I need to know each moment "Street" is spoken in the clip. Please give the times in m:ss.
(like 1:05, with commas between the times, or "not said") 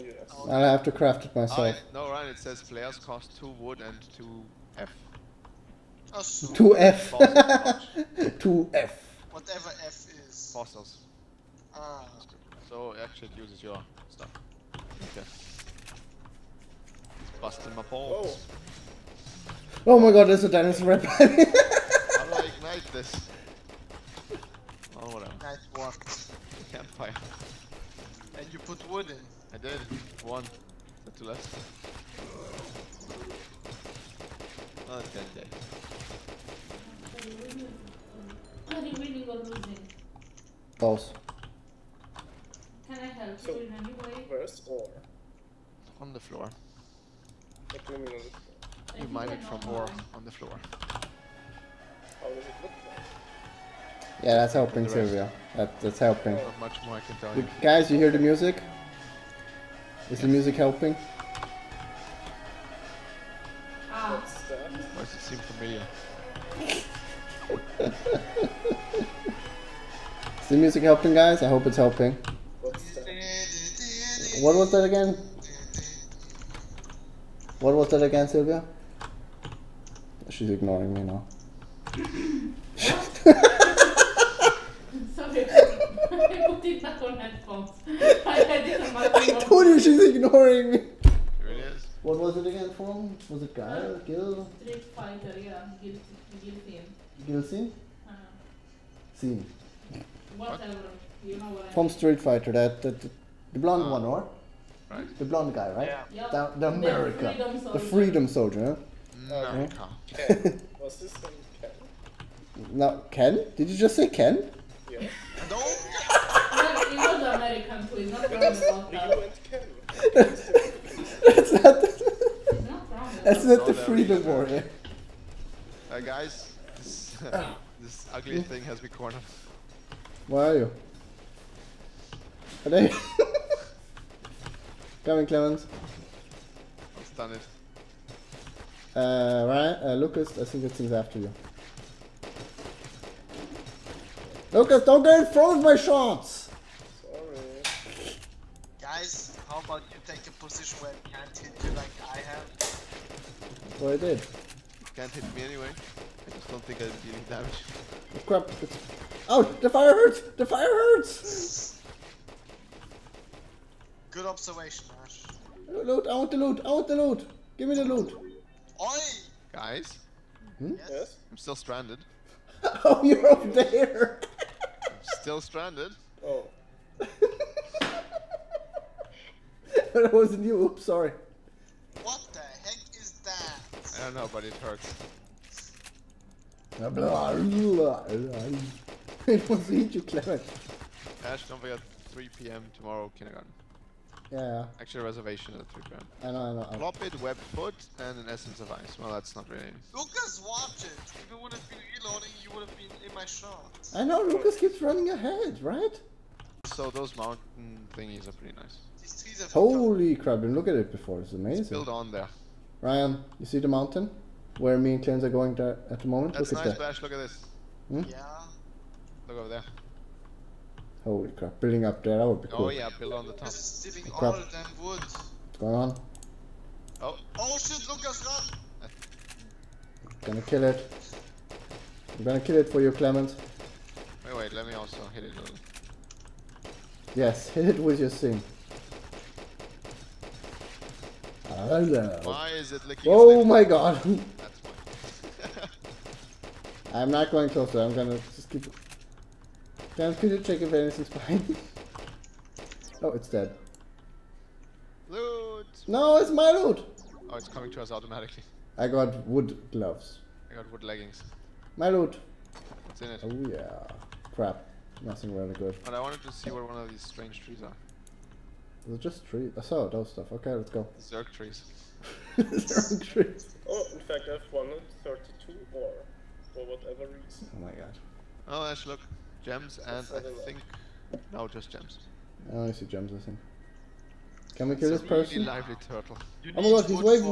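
1:34, 1:41.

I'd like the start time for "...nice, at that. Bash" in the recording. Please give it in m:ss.
3:36.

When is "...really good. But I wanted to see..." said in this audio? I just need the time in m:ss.
4:25.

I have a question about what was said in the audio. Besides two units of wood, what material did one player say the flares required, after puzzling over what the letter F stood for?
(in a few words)
Fossils.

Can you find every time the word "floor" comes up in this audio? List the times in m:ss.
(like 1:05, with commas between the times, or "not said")
0:46, 0:50.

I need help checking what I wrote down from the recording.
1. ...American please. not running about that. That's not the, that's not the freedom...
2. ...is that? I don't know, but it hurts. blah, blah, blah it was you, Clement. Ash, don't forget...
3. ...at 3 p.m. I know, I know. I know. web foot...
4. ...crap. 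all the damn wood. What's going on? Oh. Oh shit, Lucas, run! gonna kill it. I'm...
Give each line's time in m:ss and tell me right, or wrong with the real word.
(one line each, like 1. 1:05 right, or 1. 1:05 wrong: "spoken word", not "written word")
1. 1:57 wrong: "wrong", not "running"
2. 3:02 right
3. 3:15 right
4. 3:44 right.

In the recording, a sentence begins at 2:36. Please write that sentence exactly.
I just don't think I am any damage.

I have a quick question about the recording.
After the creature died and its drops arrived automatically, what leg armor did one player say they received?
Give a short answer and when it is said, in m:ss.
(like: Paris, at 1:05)
wood leggings, at 4:20.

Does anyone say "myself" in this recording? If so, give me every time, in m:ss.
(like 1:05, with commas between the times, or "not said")
0:01.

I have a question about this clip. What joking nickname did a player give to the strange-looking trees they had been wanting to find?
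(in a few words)
Zerg trees.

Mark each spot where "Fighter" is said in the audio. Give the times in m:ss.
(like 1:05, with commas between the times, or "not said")
1:34, 1:42.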